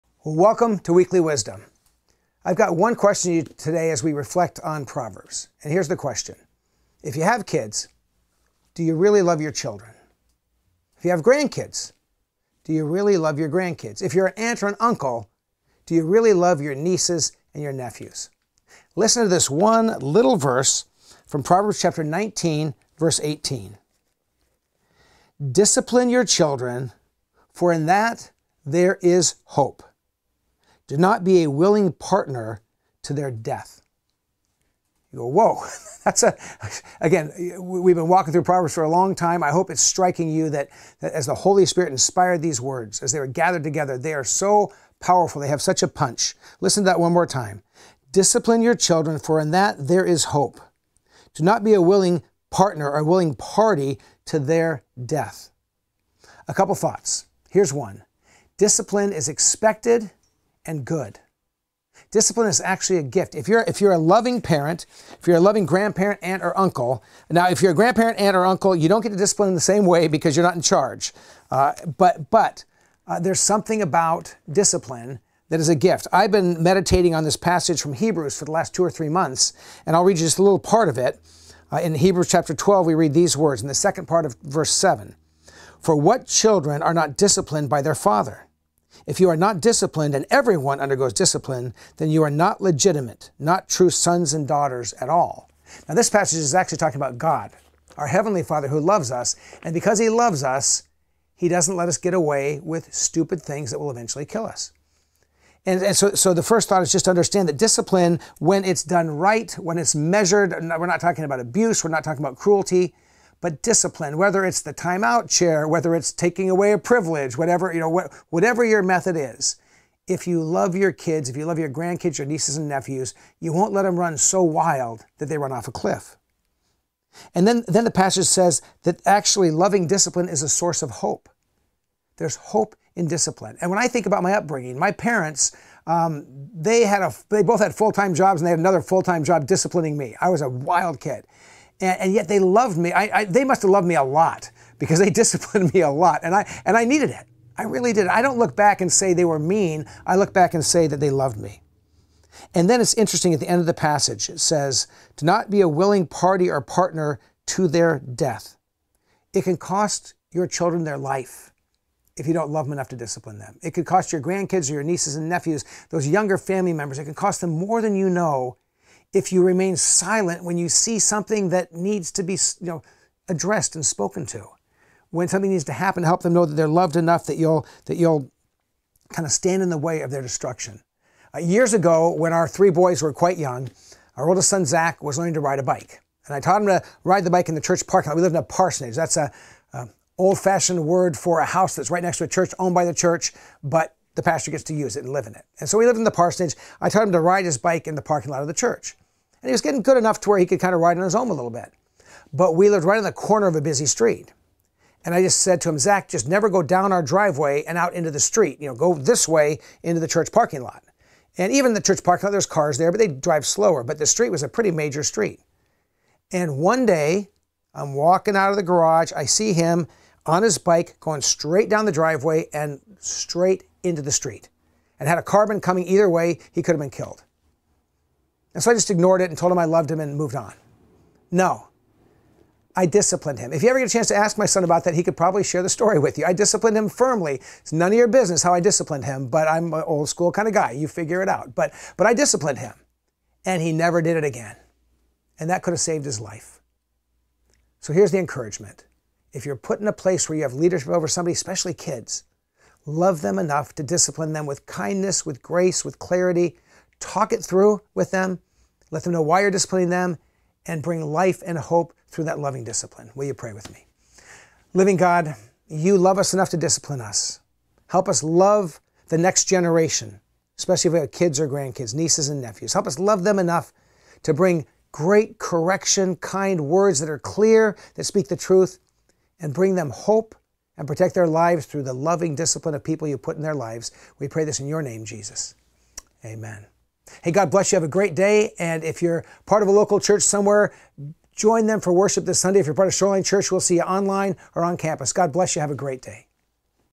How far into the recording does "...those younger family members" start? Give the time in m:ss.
2:45.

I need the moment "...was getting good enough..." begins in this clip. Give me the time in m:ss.
3:19.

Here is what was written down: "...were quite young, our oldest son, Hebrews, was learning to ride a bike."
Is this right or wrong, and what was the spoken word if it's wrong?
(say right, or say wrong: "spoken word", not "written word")
wrong: "Zach", not "Hebrews".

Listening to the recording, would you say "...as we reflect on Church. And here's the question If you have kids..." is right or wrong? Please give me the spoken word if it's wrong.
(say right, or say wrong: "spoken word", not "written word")
wrong: "Proverbs", not "Church".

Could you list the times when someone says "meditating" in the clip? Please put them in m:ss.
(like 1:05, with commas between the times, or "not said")
1:16.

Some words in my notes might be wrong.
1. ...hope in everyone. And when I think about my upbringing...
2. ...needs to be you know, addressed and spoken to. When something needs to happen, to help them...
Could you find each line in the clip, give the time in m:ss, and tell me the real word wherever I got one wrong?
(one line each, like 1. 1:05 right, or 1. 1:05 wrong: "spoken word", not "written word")
1. 2:12 wrong: "discipline", not "everyone"
2. 2:51 right.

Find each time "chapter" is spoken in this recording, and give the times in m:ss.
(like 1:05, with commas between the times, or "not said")
0:21, 1:22.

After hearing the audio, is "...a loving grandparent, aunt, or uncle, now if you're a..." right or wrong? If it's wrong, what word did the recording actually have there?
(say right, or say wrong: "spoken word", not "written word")
right.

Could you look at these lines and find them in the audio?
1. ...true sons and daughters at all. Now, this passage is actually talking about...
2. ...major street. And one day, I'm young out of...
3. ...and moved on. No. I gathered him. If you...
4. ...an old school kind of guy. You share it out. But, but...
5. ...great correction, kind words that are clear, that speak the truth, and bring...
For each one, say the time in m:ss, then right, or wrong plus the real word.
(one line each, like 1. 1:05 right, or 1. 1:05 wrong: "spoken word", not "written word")
1. 1:33 right
2. 3:34 wrong: "walking", not "young"
3. 3:49 wrong: "disciplined", not "gathered"
4. 3:59 wrong: "figure", not "share"
5. 4:34 right.